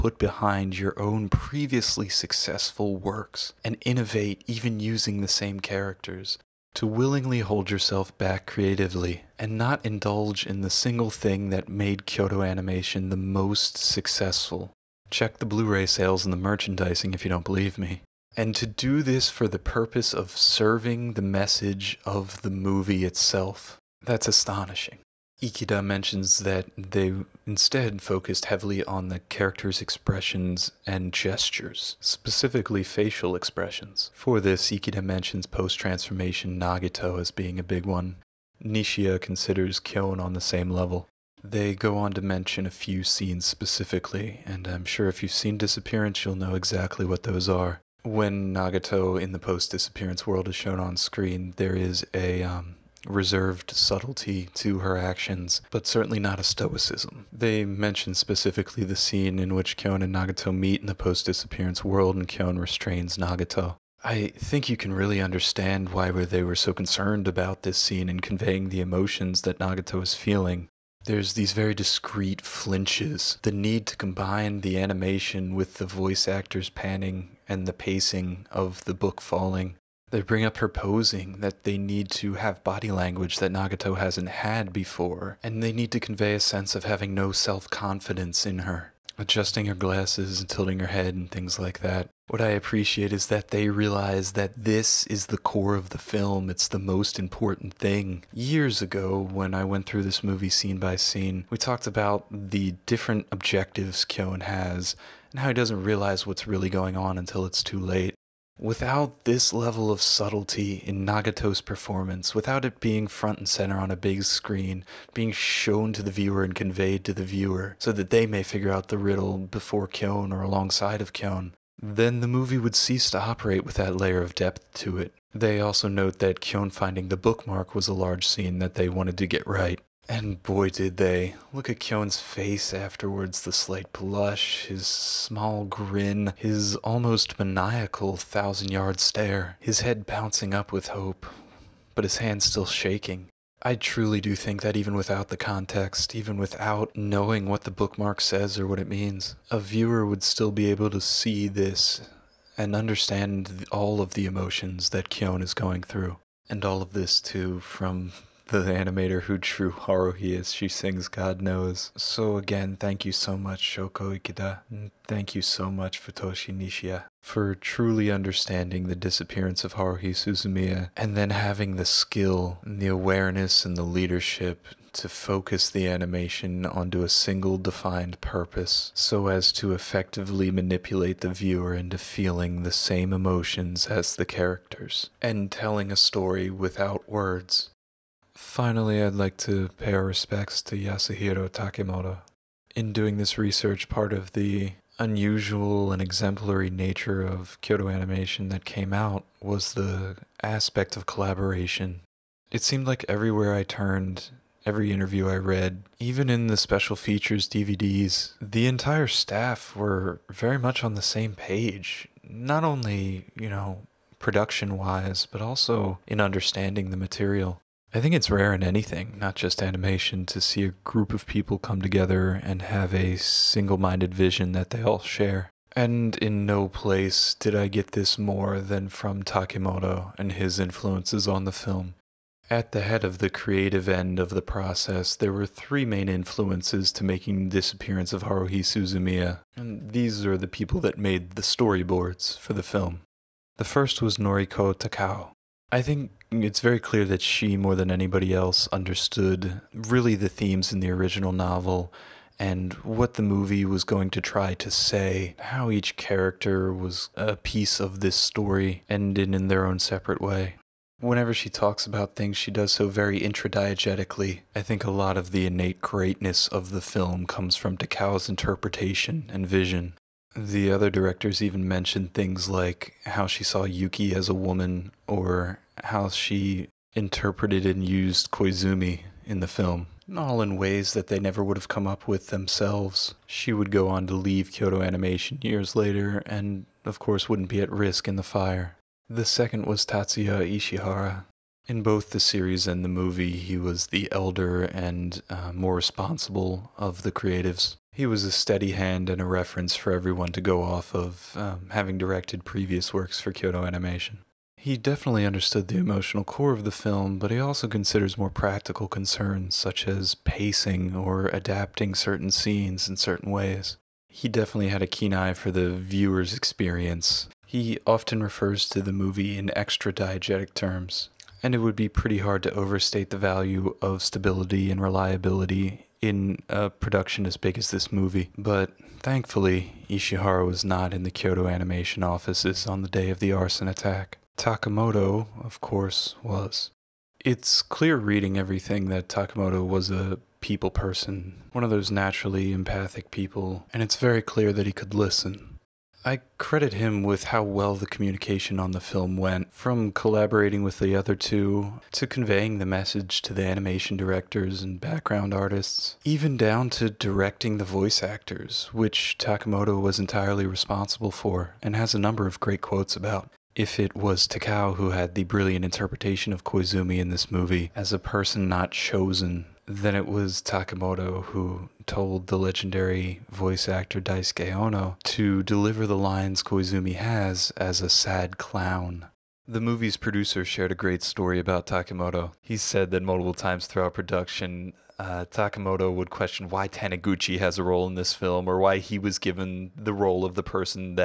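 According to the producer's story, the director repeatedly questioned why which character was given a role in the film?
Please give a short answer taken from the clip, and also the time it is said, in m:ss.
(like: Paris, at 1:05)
Taniguchi, at 6:26.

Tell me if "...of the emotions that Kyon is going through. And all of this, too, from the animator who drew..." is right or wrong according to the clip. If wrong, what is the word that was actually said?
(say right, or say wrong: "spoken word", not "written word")
right.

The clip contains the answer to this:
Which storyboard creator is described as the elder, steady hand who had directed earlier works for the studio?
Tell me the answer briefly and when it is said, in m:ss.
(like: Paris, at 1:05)
Tatsuya Ishihara, at 4:49.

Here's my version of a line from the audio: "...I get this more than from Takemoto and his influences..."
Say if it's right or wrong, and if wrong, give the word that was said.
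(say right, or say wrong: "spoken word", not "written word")
right.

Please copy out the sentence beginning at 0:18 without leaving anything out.
And to do this for the purpose of serving the message of the movie itself.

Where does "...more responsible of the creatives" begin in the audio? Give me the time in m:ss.
4:55.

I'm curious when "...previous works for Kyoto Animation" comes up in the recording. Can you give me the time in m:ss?
5:02.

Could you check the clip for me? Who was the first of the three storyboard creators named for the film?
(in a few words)
Noriko Takao.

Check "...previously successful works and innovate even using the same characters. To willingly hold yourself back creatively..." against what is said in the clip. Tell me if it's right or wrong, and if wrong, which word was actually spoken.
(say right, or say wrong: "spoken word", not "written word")
right.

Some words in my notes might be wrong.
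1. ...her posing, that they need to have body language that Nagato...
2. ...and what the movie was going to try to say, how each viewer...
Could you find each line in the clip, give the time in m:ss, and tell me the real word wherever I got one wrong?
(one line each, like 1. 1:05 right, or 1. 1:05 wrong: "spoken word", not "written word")
1. 1:20 right
2. 4:12 wrong: "character", not "viewer".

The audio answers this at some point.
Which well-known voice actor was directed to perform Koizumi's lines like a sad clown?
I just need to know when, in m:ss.
6:14.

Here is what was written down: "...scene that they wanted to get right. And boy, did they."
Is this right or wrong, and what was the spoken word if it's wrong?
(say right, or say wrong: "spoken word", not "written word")
right.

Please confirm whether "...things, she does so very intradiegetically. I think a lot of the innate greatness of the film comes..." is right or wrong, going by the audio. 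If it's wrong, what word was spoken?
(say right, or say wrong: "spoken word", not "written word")
right.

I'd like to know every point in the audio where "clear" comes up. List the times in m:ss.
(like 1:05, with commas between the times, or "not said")
4:06, 5:37, 5:44.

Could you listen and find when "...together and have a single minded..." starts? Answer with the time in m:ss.
3:41.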